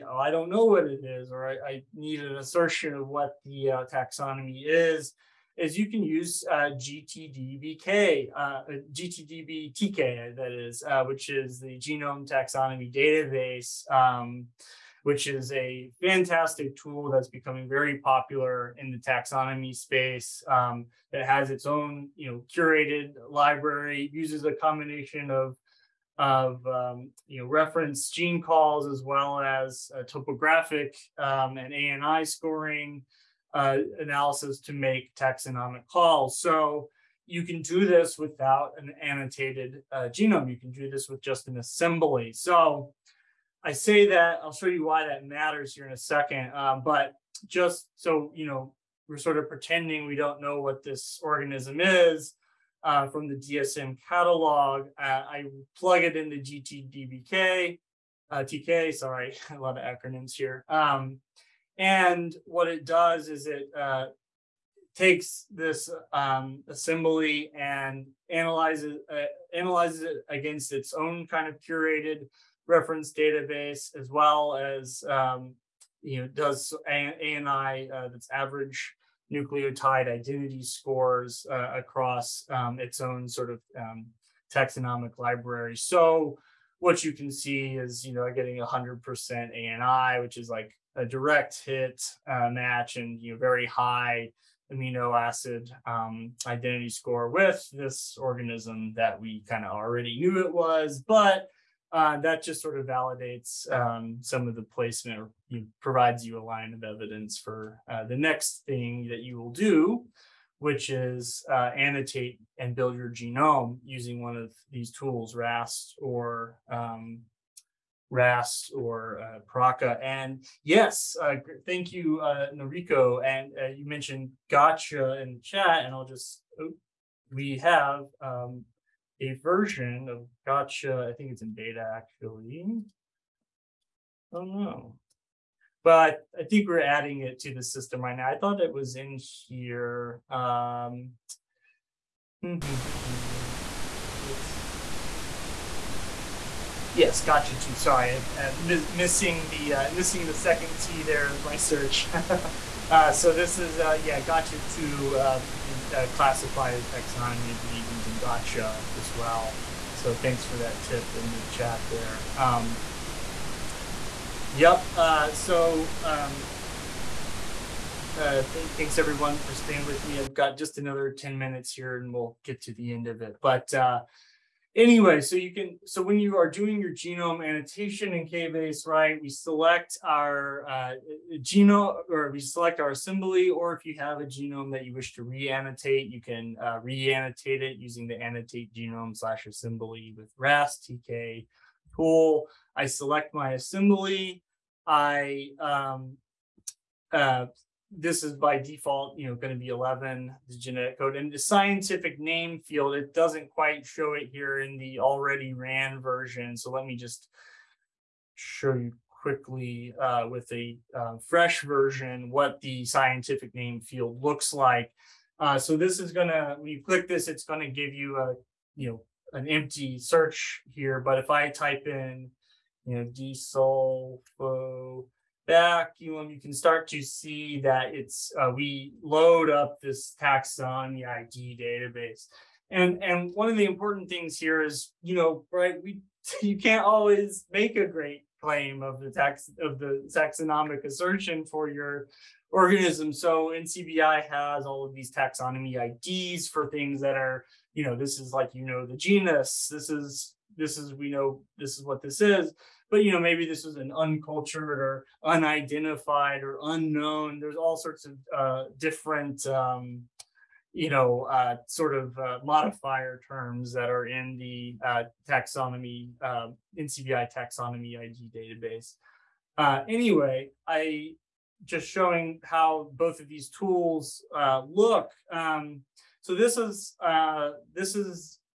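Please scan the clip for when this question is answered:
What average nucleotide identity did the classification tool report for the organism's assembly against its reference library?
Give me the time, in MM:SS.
01:28.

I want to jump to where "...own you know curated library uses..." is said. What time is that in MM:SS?
00:21.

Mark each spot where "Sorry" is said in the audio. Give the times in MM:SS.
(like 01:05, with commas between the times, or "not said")
00:58, 02:27.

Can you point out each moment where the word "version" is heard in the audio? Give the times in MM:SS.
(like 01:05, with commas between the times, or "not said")
02:09, 03:26, 03:31.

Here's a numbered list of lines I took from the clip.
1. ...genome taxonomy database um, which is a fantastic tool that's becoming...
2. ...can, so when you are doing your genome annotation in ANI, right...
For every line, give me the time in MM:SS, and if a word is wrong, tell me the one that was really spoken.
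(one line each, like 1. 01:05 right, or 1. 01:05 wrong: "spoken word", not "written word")
1. 00:11 right
2. 02:55 wrong: "KBase", not "ANI".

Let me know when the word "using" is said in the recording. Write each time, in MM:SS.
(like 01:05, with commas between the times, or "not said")
01:53, 02:37, 03:07.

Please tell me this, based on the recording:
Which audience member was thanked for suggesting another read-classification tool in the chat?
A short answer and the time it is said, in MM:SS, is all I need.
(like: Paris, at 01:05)
Noriko, at 02:02.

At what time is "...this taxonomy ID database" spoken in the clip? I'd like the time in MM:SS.
03:49.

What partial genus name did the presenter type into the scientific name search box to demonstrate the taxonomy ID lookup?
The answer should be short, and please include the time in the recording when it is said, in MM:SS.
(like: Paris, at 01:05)
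desulfo, at 03:43.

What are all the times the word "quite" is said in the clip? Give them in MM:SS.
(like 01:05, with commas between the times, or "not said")
03:23.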